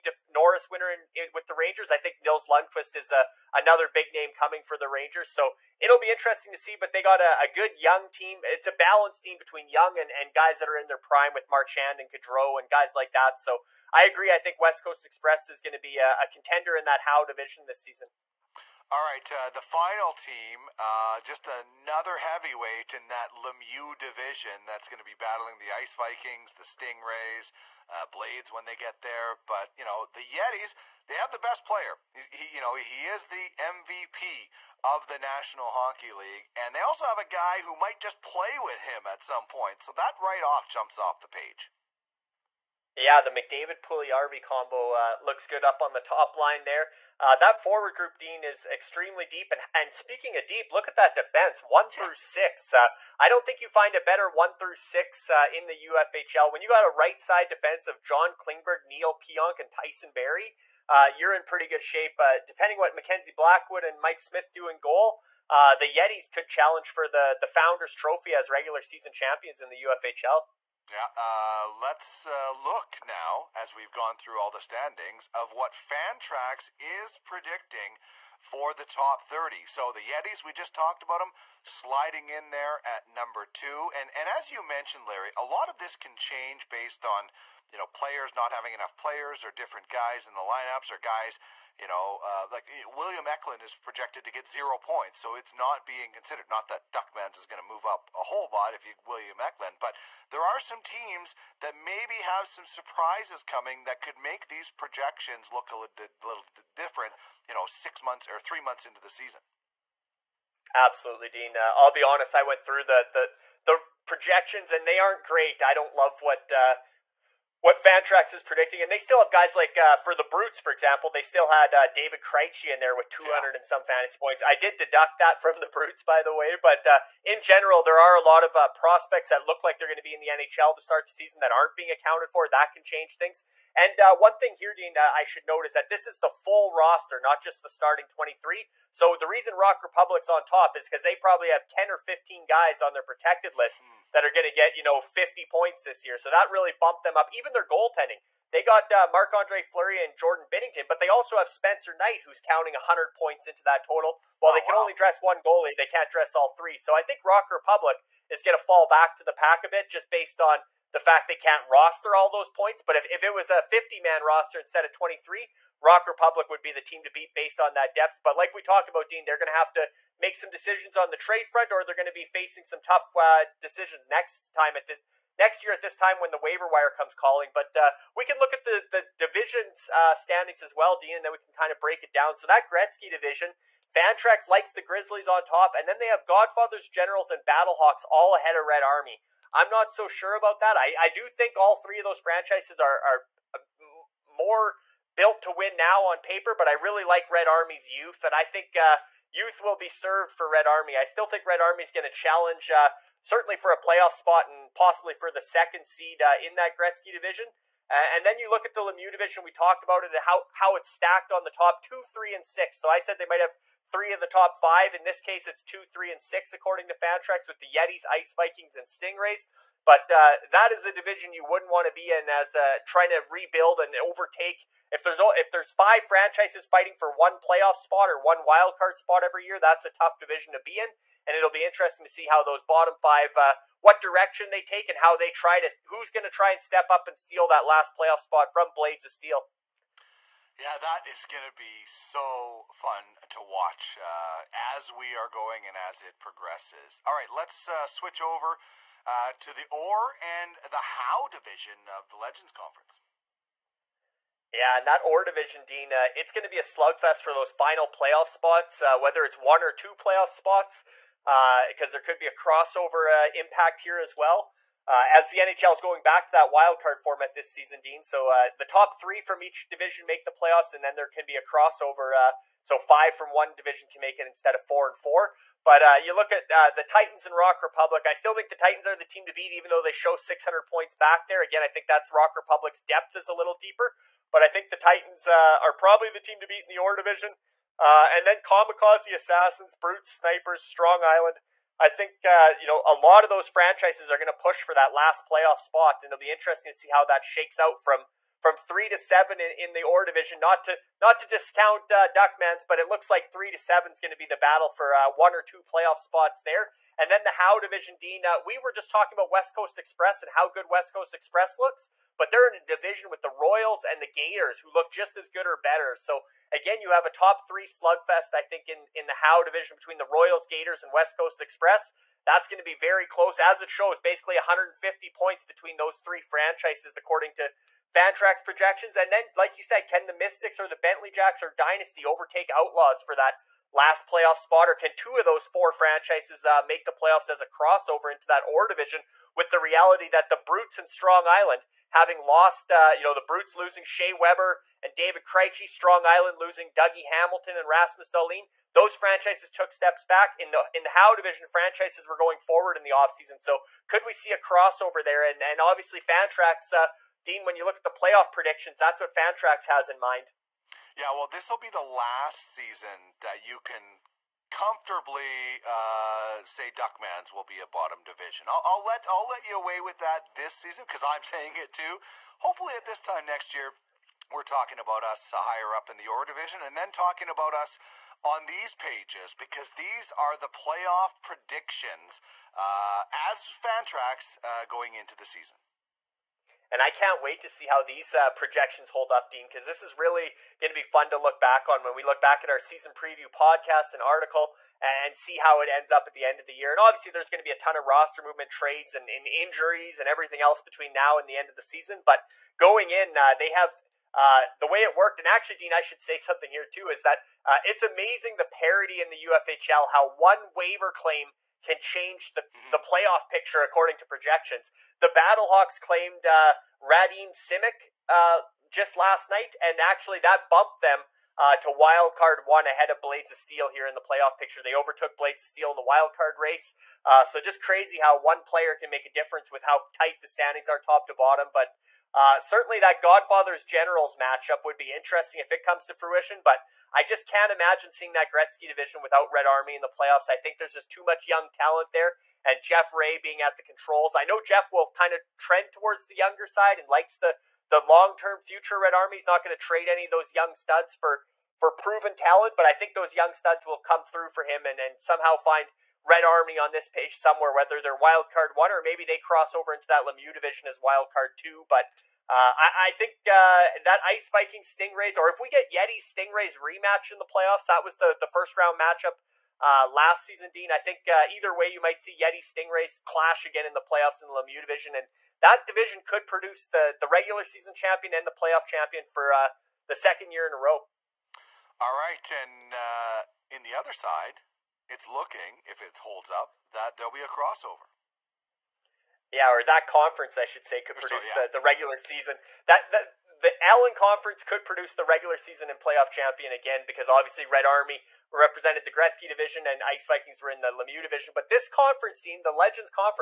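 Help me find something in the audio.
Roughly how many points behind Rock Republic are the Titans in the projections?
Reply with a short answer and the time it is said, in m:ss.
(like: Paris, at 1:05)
600, at 4:40.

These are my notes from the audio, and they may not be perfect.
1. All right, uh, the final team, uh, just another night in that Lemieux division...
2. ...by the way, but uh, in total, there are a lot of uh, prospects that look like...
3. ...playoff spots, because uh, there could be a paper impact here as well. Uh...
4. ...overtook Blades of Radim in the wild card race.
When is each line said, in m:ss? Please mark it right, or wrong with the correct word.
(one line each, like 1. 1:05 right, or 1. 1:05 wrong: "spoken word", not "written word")
1. 0:18 wrong: "heavyweight", not "night"
2. 2:06 wrong: "general", not "total"
3. 4:19 wrong: "crossover", not "paper"
4. 7:04 wrong: "Steel", not "Radim".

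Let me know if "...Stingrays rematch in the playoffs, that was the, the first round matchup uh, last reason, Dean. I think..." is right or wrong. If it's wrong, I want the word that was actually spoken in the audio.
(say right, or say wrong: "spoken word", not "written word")
wrong: "season", not "reason".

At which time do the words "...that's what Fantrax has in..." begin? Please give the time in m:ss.
5:58.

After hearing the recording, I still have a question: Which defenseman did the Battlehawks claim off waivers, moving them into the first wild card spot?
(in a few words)
Radim Simek.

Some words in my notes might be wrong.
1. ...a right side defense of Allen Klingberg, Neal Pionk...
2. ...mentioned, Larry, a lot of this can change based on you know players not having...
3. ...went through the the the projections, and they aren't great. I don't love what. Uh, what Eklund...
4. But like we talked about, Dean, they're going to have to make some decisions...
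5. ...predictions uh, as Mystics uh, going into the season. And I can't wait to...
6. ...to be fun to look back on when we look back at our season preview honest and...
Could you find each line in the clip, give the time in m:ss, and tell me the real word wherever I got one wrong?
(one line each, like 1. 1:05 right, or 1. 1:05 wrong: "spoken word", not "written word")
1. 0:56 wrong: "John", not "Allen"
2. 1:24 right
3. 1:52 wrong: "Fantrax", not "Eklund"
4. 2:48 right
5. 6:21 wrong: "Fantrax", not "Mystics"
6. 6:30 wrong: "podcast", not "honest".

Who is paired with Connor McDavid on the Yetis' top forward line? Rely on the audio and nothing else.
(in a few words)
Puljujarvi.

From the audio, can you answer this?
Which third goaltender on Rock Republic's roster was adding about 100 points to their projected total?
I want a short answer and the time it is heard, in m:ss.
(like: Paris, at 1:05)
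Spencer Knight, at 2:31.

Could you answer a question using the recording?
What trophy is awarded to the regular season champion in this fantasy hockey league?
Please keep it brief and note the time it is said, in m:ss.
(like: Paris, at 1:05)
Founders Trophy, at 1:07.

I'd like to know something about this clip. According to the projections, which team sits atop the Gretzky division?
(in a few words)
Grizzlies.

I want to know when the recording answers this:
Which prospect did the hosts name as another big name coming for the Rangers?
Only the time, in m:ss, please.
0:02.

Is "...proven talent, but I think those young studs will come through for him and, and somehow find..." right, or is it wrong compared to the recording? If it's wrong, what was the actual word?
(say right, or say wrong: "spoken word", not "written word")
right.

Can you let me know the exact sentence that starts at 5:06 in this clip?
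And then the Howe division, Dean.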